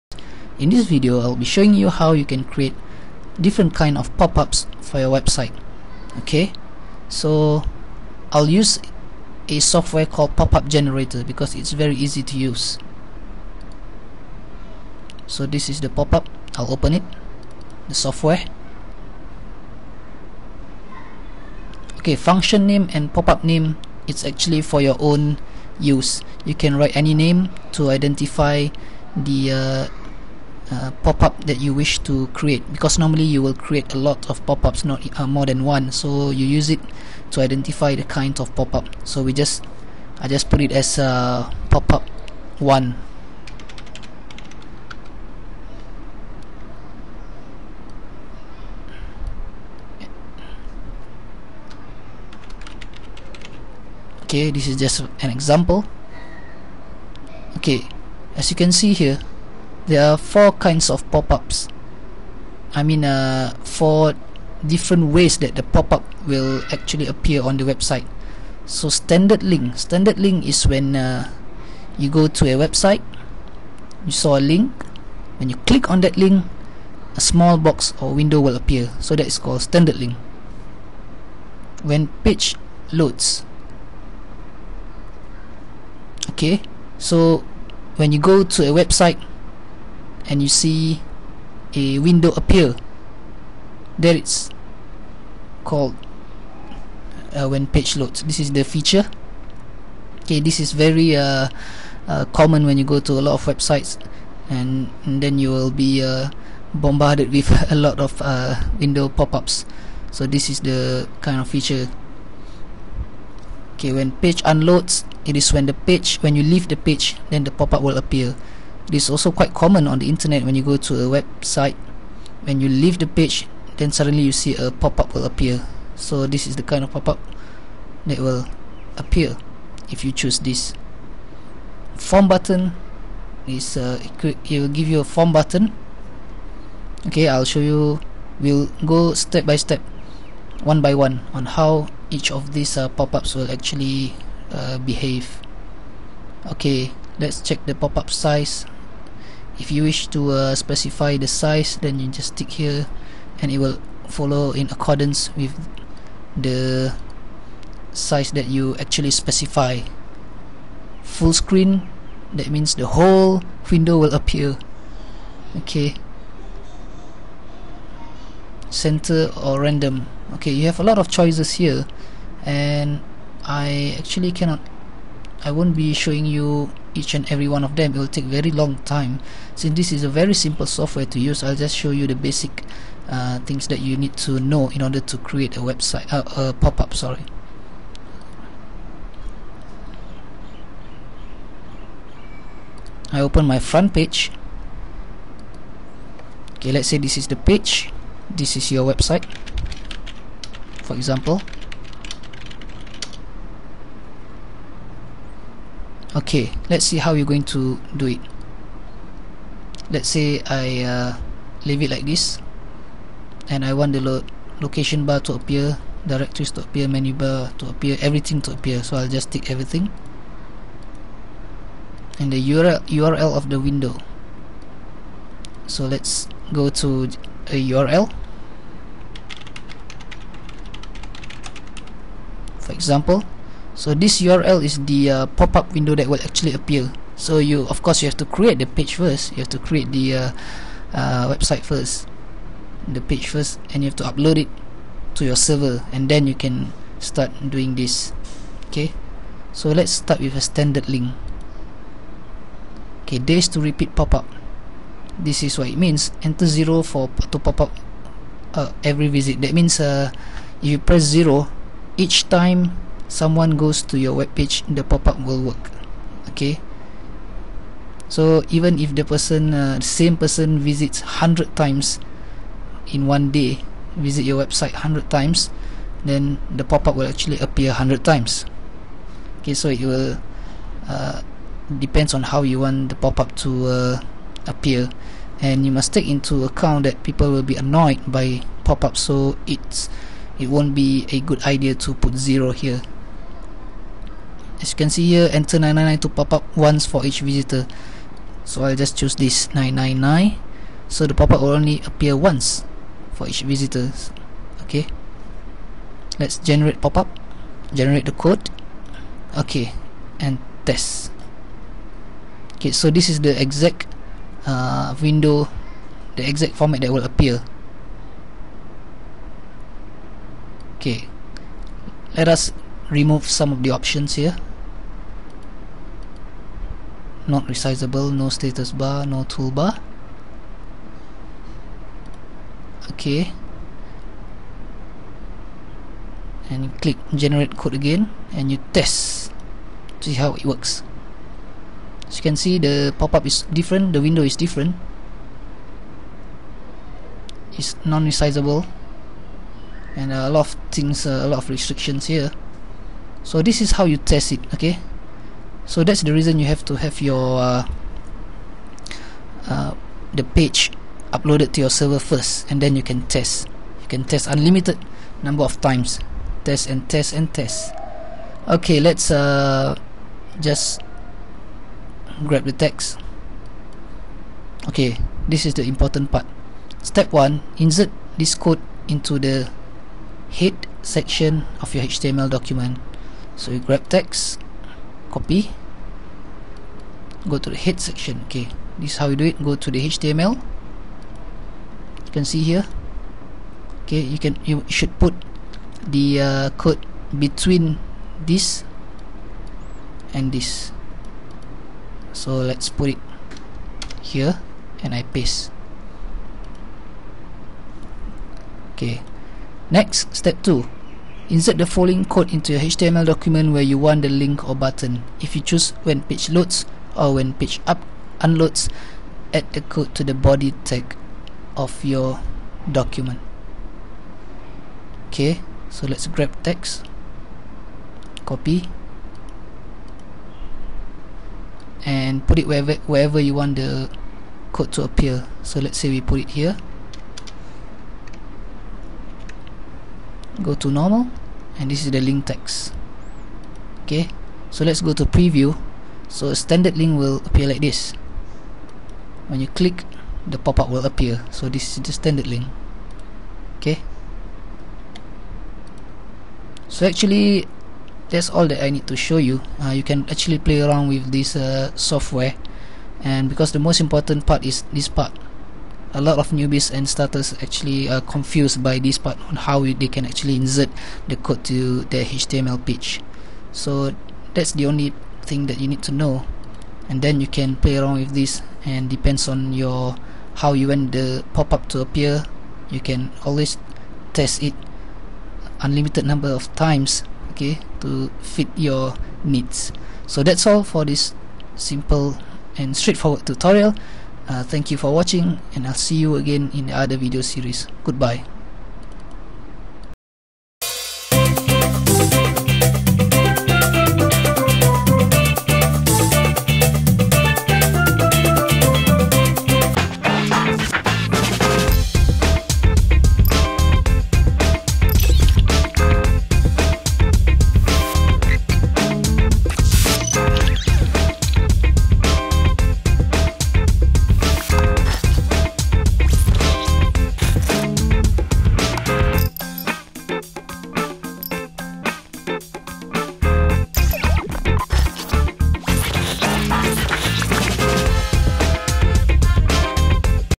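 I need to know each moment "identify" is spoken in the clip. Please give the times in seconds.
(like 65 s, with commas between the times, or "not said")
27 s, 37 s.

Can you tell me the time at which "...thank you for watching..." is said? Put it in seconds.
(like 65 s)
494 s.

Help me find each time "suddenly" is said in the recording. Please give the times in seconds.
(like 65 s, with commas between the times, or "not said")
123 s.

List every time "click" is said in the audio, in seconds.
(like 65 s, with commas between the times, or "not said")
75 s, 336 s, 449 s.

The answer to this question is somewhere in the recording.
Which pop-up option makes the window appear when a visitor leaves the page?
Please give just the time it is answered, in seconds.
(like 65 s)
113 s.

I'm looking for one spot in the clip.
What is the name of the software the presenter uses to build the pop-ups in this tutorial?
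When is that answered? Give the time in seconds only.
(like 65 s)
10 s.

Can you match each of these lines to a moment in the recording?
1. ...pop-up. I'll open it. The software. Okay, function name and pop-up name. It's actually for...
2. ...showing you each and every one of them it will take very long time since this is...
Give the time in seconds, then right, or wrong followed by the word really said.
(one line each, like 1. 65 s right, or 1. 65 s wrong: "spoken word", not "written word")
1. 15 s right
2. 175 s right.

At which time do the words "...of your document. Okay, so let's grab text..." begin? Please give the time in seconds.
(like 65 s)
421 s.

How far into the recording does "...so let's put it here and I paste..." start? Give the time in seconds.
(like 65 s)
402 s.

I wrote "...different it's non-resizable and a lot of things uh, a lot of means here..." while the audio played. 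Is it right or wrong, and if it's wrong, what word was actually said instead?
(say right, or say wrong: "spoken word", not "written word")
wrong: "restrictions", not "means".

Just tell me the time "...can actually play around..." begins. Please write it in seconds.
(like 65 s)
459 s.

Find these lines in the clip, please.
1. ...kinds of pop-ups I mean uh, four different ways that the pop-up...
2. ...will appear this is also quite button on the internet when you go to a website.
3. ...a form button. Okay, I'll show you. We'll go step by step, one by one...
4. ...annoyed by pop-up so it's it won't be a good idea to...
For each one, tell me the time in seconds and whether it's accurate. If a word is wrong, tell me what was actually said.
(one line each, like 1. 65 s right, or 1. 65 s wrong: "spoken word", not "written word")
1. 60 s right
2. 117 s wrong: "common", not "button"
3. 135 s right
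4. 287 s right.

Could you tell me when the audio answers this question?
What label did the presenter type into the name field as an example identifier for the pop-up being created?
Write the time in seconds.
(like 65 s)
41 s.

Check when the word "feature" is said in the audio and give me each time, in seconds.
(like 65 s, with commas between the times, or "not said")
98 s, 111 s.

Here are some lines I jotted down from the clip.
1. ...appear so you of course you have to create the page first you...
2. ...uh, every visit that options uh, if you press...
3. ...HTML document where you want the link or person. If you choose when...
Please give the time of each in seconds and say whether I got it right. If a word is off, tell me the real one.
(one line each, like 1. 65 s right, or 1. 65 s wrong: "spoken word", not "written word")
1. 236 s right
2. 258 s wrong: "means", not "options"
3. 412 s wrong: "button", not "person".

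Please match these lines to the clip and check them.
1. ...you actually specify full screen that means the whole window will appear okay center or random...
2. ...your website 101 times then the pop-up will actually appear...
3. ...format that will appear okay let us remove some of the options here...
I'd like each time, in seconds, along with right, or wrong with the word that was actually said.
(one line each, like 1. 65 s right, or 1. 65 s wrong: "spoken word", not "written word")
1. 158 s right
2. 274 s wrong: "100", not "101"
3. 316 s right.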